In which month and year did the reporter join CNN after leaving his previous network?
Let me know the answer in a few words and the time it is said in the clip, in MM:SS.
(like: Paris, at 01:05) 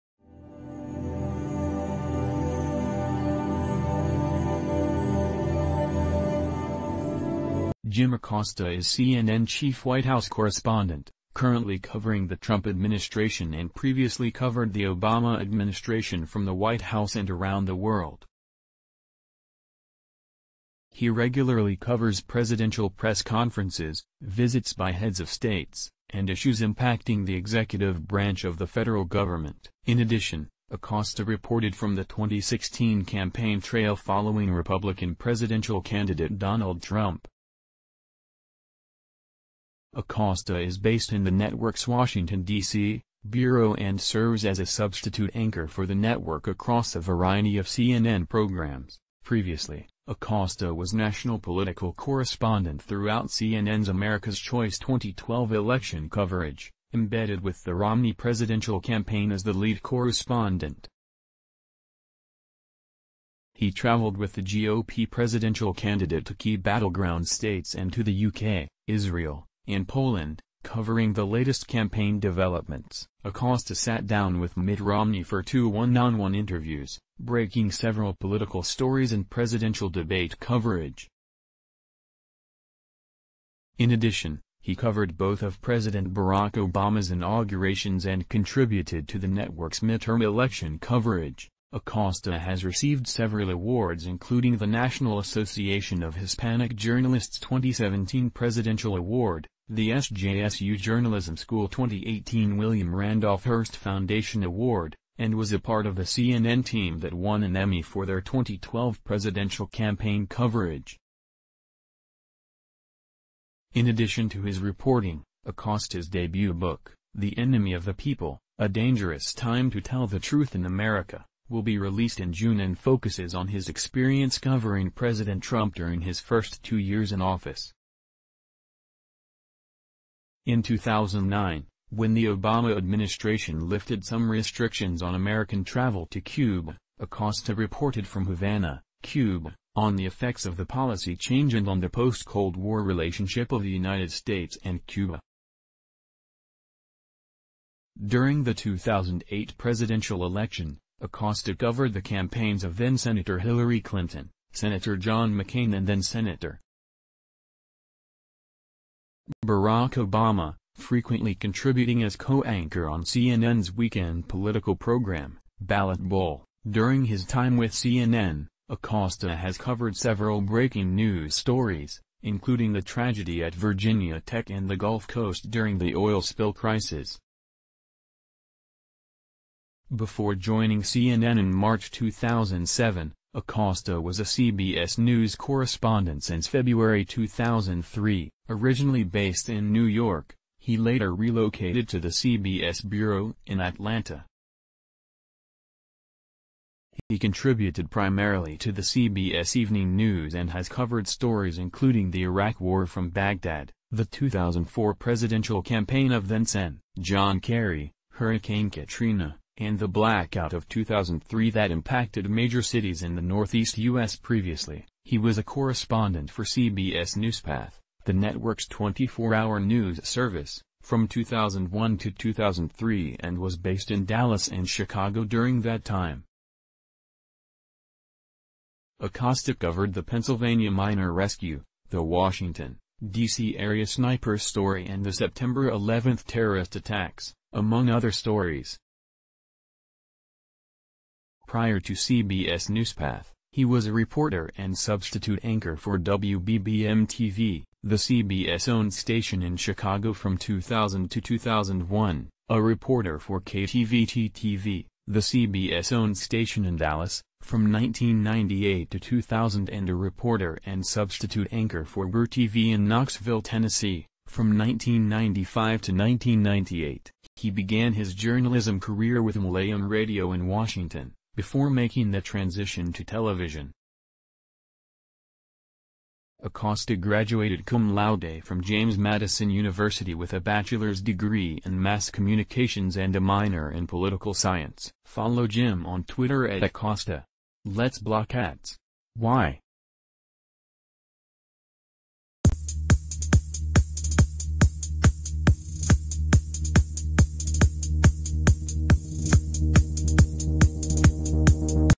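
March 2007, at 03:01.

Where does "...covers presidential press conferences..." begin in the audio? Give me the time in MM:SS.
00:21.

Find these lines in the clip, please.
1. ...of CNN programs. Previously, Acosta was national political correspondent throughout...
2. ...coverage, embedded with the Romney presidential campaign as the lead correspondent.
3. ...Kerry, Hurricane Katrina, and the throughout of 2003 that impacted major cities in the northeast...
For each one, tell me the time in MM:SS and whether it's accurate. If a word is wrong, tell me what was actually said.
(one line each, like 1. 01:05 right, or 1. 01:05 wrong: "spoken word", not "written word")
1. 00:47 right
2. 00:56 right
3. 03:27 wrong: "blackout", not "throughout".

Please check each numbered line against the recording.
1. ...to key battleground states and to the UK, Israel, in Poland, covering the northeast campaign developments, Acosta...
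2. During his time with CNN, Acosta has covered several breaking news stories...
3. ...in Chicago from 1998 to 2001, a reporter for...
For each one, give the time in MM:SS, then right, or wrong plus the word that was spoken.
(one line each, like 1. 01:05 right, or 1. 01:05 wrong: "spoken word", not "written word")
1. 01:06 wrong: "latest", not "northeast"
2. 02:46 right
3. 04:09 wrong: "2000", not "1998".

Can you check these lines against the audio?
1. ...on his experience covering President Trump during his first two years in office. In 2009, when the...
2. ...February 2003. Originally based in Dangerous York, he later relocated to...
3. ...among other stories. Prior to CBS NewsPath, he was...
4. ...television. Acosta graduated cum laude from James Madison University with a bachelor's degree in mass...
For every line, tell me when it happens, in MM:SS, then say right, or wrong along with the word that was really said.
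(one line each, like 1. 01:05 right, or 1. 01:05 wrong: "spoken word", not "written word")
1. 02:03 right
2. 03:06 wrong: "New", not "Dangerous"
3. 03:57 right
4. 04:33 right.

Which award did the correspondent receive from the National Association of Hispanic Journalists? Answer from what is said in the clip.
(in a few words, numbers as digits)
2017 Presidential Award.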